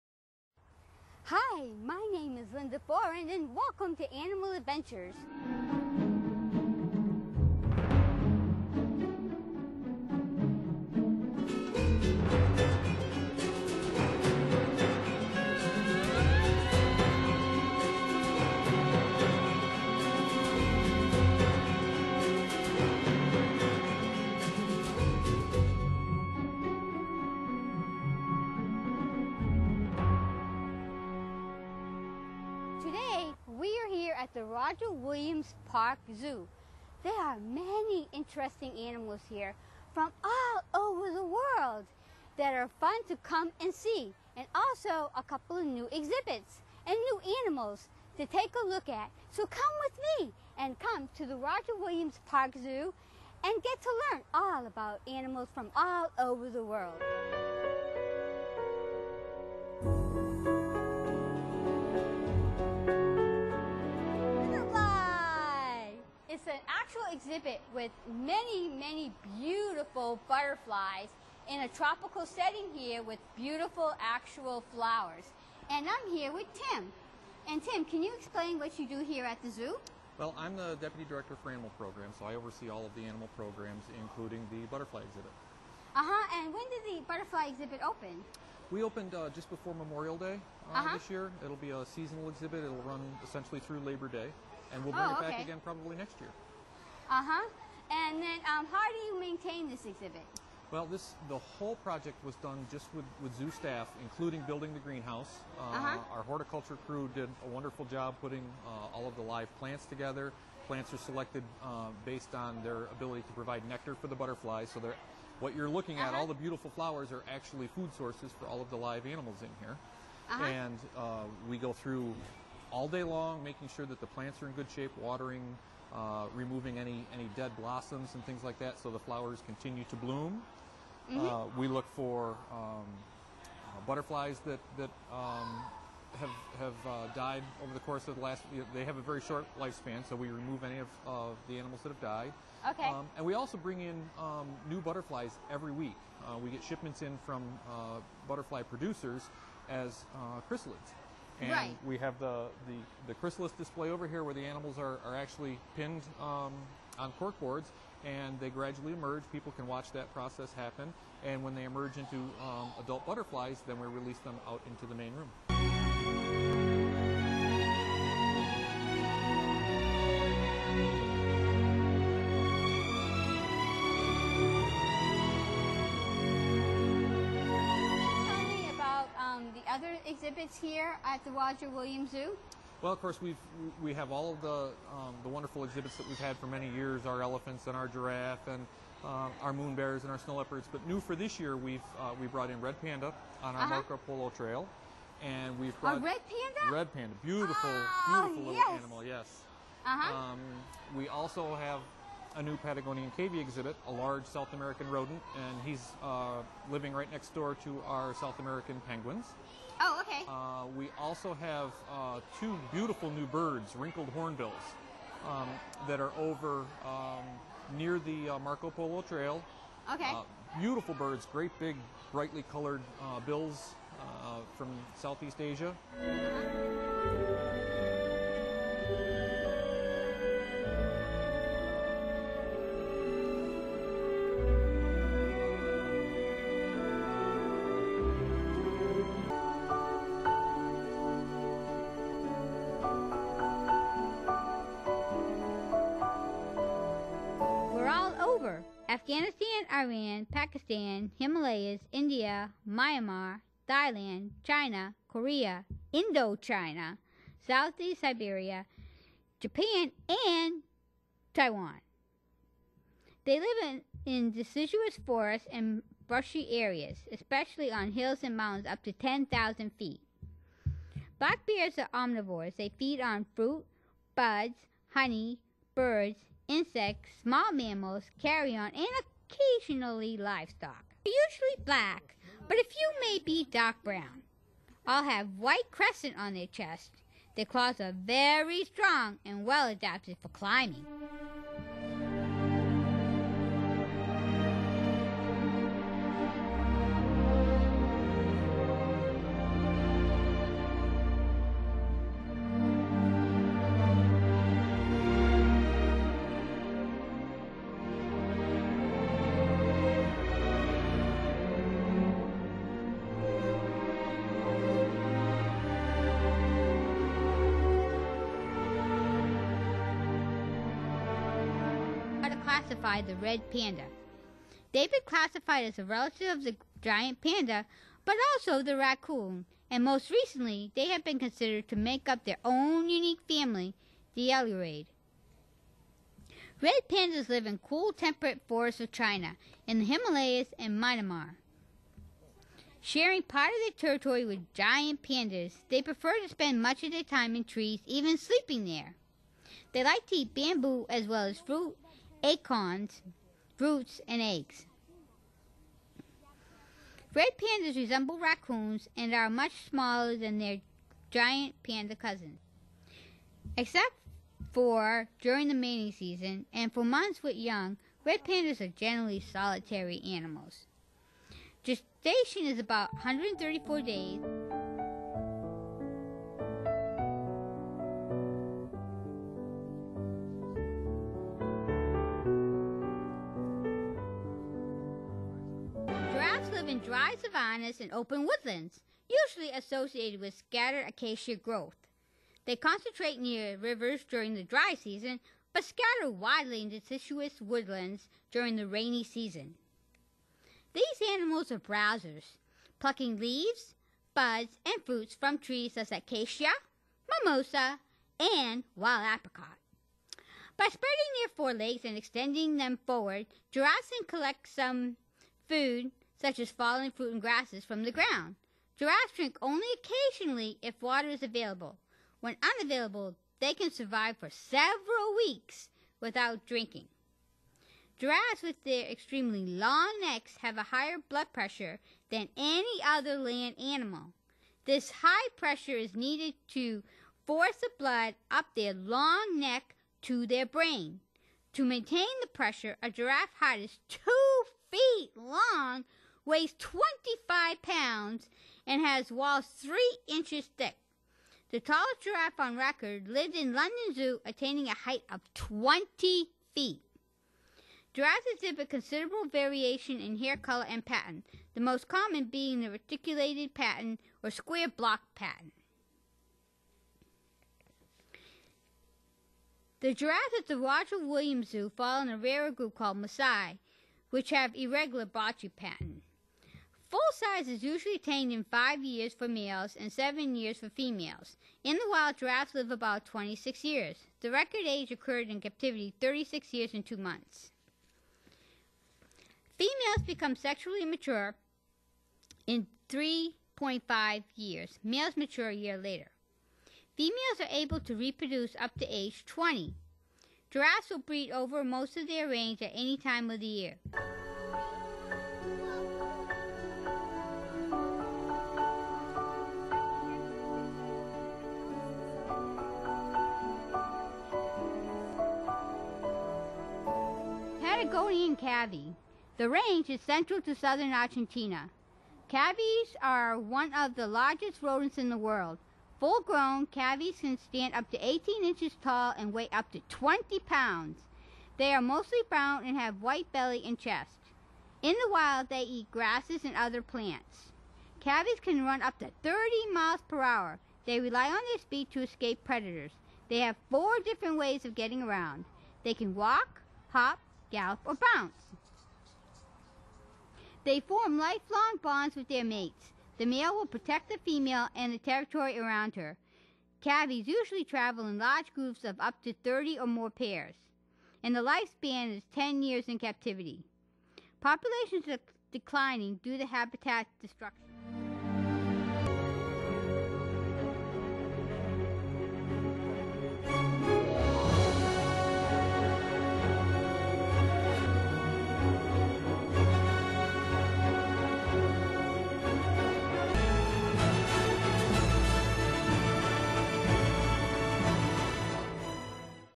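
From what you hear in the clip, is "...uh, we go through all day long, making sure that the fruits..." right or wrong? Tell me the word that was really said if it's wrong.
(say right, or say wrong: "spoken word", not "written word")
wrong: "plants", not "fruits".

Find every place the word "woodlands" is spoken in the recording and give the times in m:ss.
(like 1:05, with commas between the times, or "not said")
6:28, 6:37.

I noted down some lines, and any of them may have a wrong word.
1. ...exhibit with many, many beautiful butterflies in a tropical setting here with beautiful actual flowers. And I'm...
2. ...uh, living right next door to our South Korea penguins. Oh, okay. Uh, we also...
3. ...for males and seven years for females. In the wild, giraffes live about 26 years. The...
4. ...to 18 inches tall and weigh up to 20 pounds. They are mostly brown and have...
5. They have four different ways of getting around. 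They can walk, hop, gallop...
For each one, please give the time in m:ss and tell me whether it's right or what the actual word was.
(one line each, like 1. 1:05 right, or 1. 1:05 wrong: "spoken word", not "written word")
1. 1:07 right
2. 3:26 wrong: "American", not "Korea"
3. 7:59 right
4. 8:47 right
5. 9:03 right.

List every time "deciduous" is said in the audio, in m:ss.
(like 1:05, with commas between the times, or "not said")
4:24, 6:36.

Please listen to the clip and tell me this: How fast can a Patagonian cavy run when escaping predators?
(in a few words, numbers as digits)
30 miles per hour.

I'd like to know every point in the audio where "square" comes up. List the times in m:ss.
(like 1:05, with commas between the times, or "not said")
7:44.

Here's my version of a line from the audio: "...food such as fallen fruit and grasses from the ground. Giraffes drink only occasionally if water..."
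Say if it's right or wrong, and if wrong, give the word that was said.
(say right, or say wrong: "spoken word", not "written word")
right.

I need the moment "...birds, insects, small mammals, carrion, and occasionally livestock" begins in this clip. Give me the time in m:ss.
4:35.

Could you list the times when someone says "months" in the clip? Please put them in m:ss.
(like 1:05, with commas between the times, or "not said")
6:06, 8:06.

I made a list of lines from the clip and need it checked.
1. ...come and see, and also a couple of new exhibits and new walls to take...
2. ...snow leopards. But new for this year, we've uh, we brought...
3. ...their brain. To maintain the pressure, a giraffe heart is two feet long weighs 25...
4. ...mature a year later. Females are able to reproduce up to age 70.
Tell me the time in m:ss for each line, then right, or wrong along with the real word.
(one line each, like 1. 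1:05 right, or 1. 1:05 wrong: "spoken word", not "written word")
1. 0:43 wrong: "animals", not "walls"
2. 3:10 right
3. 7:20 right
4. 8:15 wrong: "20", not "70".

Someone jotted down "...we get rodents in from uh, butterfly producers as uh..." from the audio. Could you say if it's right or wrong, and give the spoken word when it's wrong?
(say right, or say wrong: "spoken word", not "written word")
wrong: "shipments", not "rodents".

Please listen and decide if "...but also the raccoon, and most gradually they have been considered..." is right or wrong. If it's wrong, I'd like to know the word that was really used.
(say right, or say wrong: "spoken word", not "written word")
wrong: "recently", not "gradually".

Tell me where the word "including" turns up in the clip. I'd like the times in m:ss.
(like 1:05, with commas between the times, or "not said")
1:24, 1:44.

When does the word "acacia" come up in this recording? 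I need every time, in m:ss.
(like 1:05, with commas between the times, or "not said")
6:30, 6:45.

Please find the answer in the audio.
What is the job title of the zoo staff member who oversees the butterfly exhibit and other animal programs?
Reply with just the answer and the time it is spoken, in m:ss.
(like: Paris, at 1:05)
Deputy Director for Animal Programs, at 1:20.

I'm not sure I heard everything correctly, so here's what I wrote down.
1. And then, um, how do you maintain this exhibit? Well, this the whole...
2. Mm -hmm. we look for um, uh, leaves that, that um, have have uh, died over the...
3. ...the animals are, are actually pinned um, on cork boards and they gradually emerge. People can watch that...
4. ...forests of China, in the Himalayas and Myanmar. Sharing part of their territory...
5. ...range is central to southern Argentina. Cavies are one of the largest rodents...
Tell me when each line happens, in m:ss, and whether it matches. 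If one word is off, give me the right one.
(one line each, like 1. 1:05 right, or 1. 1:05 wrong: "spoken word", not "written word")
1. 1:37 right
2. 2:10 wrong: "butterflies", not "leaves"
3. 2:34 right
4. 5:38 right
5. 8:39 right.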